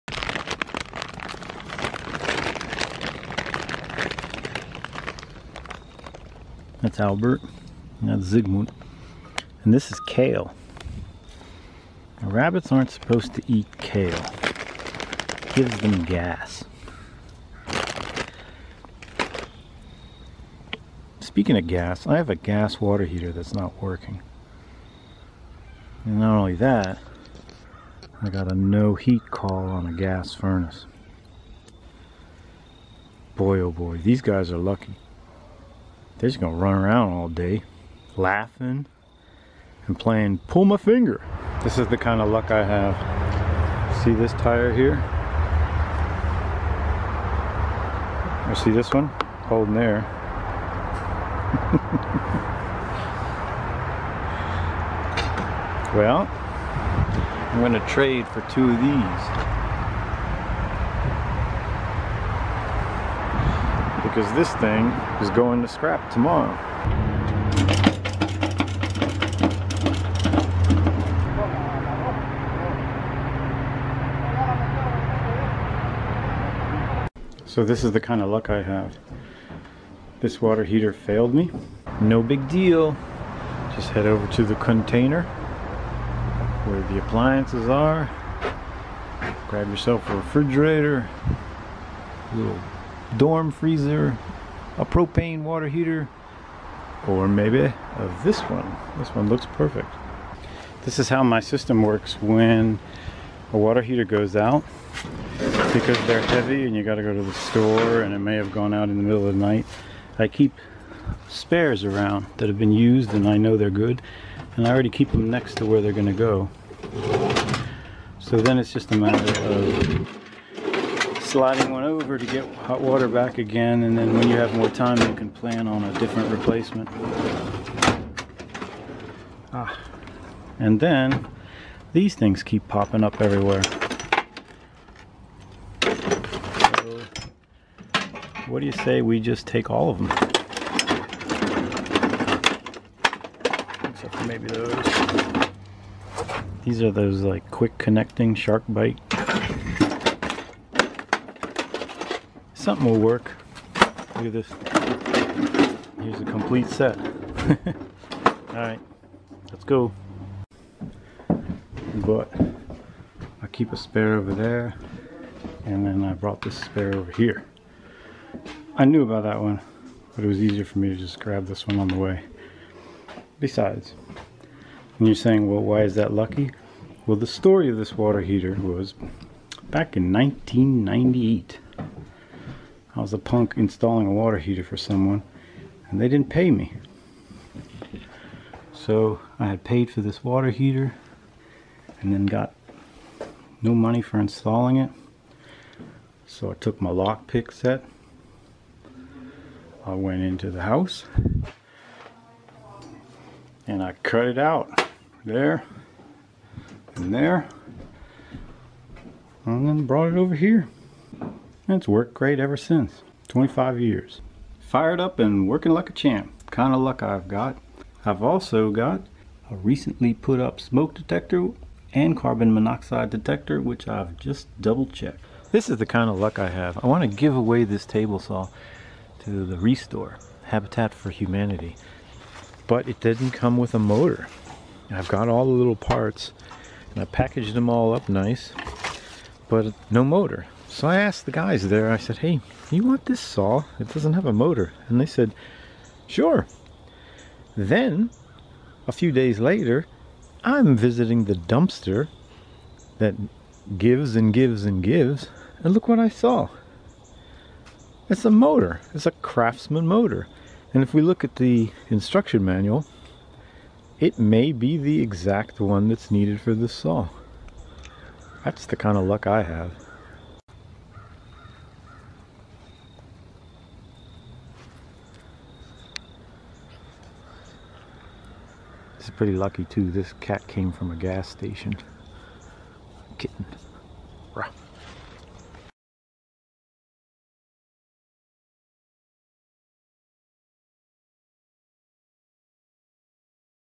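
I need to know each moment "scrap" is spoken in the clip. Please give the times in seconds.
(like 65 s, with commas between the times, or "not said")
65 s.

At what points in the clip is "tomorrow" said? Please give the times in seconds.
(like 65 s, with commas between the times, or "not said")
66 s.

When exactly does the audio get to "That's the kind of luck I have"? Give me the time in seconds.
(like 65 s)
268 s.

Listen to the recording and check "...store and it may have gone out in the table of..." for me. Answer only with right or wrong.
wrong.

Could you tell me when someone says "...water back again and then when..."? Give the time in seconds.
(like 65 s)
122 s.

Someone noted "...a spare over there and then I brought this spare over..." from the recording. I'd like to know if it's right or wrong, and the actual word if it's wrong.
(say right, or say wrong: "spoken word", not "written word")
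right.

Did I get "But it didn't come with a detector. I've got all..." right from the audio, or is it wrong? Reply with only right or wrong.
wrong.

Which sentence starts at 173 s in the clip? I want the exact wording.
Besides, and you're saying, well, why is that lucky?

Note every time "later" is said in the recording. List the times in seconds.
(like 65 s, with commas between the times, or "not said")
249 s.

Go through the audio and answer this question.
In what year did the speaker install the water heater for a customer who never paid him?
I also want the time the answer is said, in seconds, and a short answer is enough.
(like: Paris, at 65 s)
1998, at 180 s.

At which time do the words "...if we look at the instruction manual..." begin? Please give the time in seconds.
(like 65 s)
260 s.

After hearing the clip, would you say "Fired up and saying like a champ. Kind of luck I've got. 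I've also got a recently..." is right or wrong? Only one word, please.
wrong.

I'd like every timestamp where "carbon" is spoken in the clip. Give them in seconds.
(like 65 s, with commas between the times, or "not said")
222 s.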